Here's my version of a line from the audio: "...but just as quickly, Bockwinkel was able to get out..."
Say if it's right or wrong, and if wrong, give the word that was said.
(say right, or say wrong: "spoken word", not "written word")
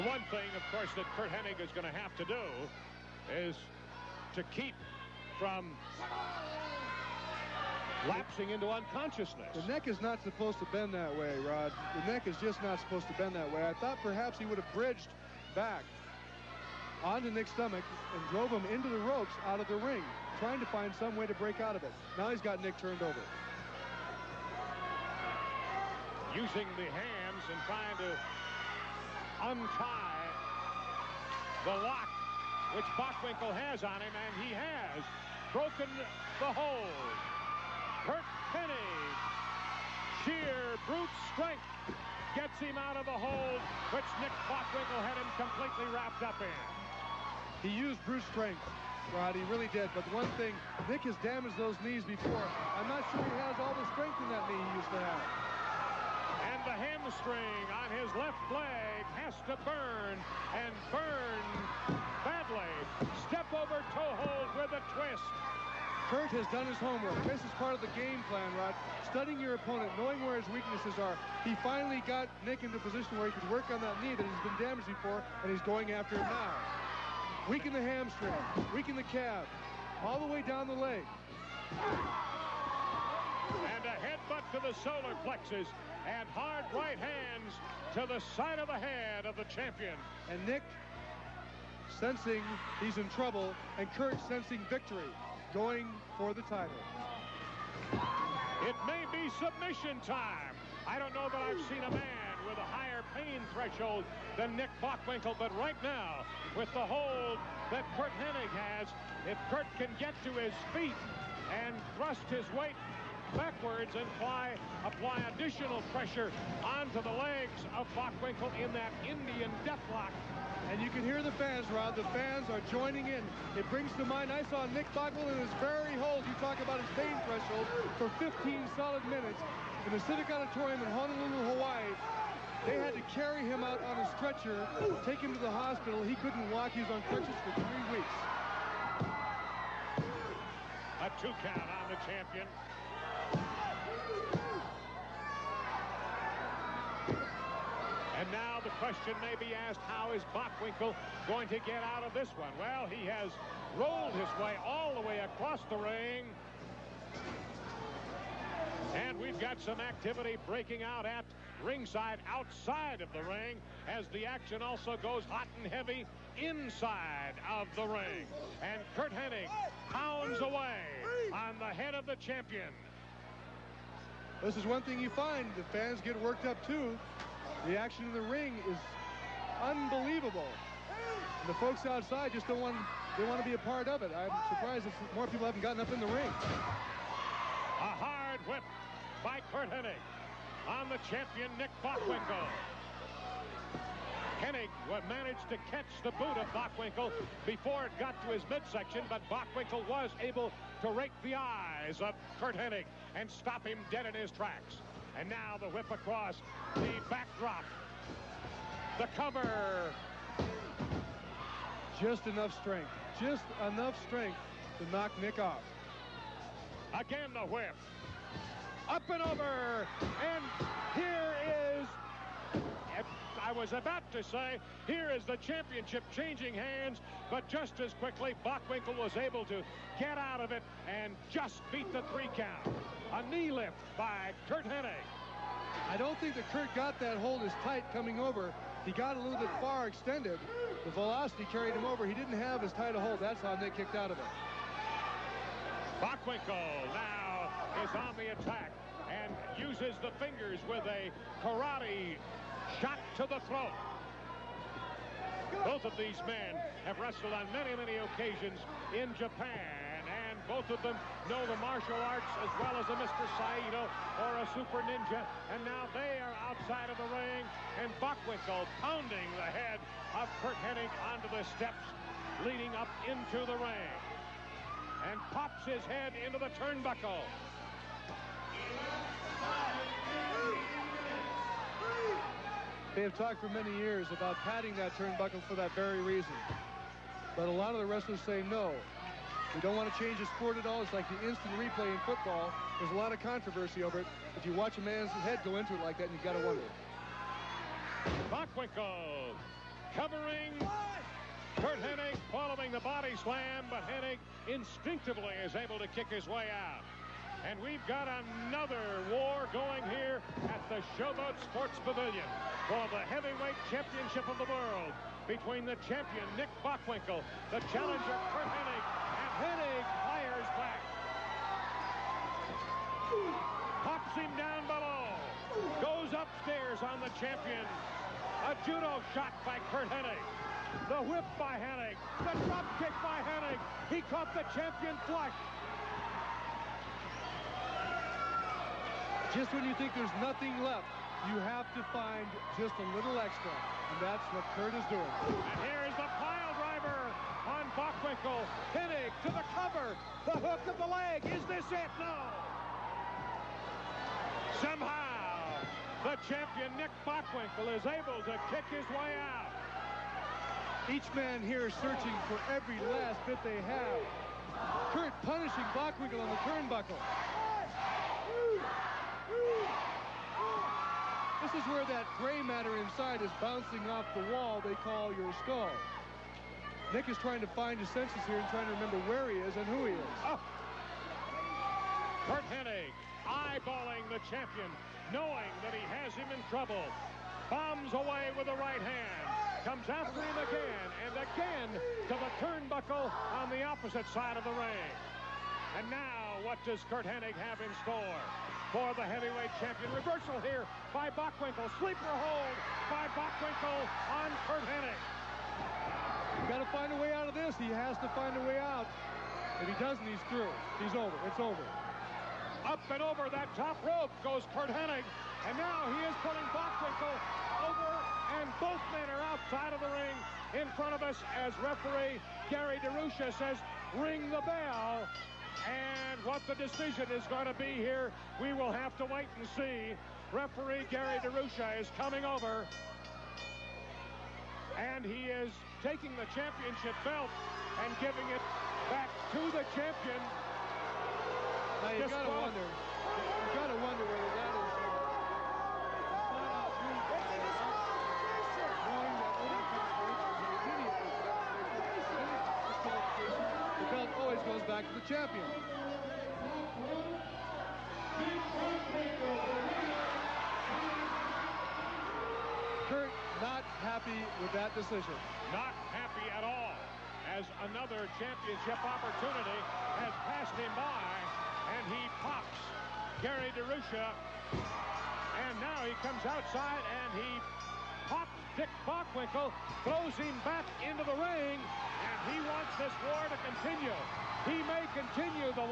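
right.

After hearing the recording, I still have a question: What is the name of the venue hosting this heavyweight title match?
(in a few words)
Showboat Sports Pavilion.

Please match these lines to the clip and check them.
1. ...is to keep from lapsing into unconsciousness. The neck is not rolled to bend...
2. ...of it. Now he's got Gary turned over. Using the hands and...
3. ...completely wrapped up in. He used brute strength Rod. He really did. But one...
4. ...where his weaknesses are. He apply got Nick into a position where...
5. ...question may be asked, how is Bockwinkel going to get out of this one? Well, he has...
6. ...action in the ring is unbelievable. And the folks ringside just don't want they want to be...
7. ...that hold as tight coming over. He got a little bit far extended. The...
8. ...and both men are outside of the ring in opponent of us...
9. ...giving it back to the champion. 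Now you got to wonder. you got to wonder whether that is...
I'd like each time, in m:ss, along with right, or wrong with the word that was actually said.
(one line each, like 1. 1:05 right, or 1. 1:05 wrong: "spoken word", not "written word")
1. 0:03 wrong: "supposed", not "rolled"
2. 0:21 wrong: "Nick", not "Gary"
3. 0:45 right
4. 1:10 wrong: "finally", not "apply"
5. 2:28 right
6. 2:57 wrong: "outside", not "ringside"
7. 3:56 right
8. 6:58 wrong: "front", not "opponent"
9. 7:18 right.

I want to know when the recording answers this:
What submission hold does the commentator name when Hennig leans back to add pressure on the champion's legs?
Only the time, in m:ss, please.
1:59.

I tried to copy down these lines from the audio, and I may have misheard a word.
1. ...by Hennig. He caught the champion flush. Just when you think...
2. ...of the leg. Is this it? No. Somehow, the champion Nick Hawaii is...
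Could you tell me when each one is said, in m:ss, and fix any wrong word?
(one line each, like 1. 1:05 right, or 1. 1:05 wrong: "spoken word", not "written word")
1. 5:33 right
2. 5:50 wrong: "Bockwinkel", not "Hawaii".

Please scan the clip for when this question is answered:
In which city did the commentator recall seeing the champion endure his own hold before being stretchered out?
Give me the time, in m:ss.
2:10.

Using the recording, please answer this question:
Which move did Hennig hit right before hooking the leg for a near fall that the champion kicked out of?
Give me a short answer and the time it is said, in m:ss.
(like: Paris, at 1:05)
Pile driver, at 5:46.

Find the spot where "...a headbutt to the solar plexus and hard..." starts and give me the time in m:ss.
1:23.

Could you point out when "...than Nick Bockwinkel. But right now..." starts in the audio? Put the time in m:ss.
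1:44.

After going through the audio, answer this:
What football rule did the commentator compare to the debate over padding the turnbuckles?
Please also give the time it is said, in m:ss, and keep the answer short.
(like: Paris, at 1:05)
Instant replay, at 4:51.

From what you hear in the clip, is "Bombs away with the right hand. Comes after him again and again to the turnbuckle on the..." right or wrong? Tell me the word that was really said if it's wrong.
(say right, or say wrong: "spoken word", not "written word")
right.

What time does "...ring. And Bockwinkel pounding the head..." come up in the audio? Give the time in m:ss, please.
4:27.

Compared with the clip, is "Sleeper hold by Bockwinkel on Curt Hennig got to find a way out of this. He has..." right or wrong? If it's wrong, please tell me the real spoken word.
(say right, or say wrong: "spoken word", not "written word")
right.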